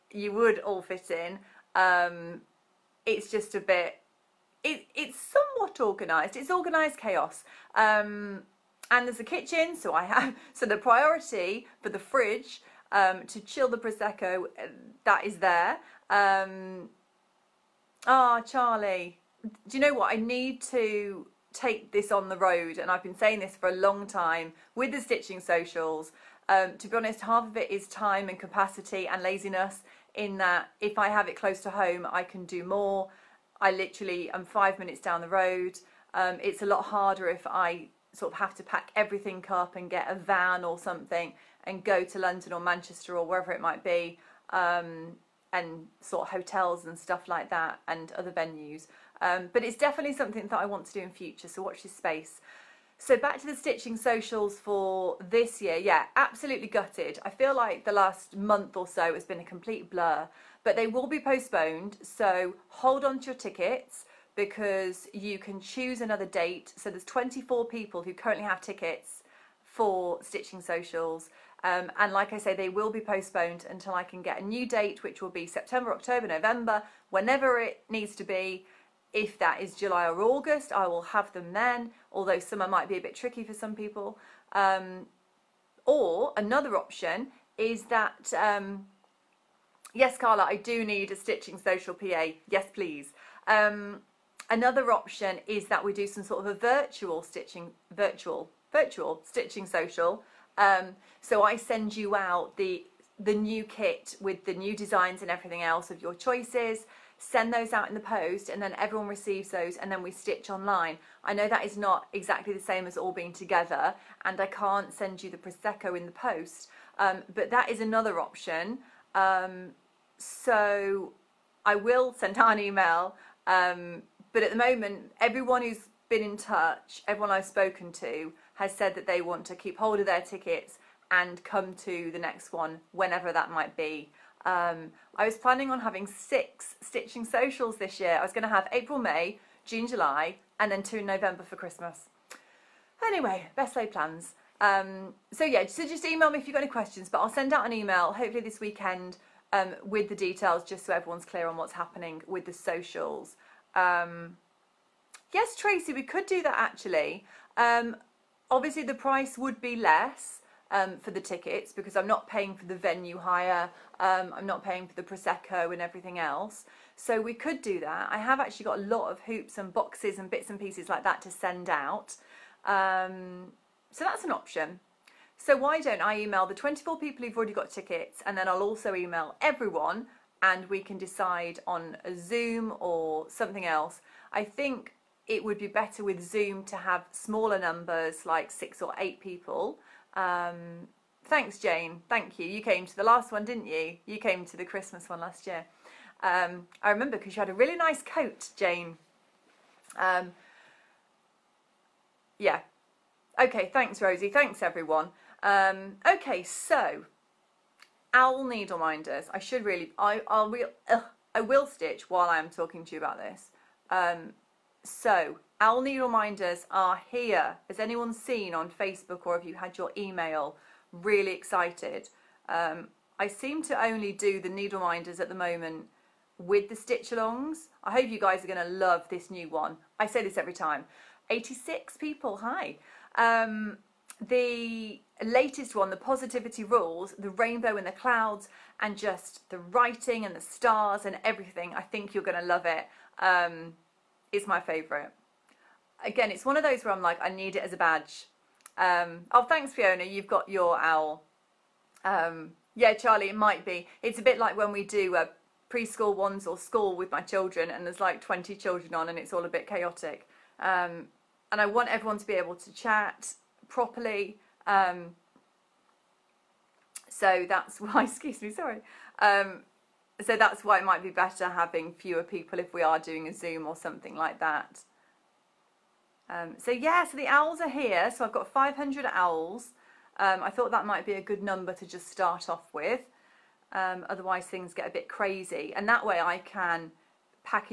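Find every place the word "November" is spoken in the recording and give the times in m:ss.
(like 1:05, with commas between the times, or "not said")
1:16, 2:21.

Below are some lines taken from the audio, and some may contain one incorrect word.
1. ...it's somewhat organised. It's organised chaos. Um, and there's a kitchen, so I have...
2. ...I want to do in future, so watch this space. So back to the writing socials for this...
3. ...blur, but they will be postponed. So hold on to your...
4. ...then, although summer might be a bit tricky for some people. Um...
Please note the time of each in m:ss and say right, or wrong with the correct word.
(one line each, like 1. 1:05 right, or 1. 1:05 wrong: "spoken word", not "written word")
1. 0:04 right
2. 0:50 wrong: "stitching", not "writing"
3. 0:59 right
4. 1:21 right.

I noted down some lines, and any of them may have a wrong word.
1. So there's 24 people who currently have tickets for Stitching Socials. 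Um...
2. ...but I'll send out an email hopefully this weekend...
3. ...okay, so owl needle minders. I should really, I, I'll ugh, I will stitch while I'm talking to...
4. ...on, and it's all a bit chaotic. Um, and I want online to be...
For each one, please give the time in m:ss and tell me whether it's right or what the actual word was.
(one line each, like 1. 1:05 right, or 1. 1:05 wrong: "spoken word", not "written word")
1. 1:06 right
2. 2:27 right
3. 3:26 right
4. 4:18 wrong: "everyone", not "online".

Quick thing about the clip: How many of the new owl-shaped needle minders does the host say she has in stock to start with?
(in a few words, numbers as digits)
500.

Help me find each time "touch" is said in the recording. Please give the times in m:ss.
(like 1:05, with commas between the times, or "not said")
2:06.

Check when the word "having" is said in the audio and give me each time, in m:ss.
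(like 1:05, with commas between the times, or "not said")
2:15, 4:31.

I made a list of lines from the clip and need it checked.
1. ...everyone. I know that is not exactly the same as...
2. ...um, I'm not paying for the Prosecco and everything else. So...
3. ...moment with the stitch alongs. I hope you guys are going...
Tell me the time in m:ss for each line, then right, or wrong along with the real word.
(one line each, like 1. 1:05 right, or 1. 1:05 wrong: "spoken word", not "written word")
1. 1:50 wrong: "online", not "everyone"
2. 2:43 right
3. 3:45 right.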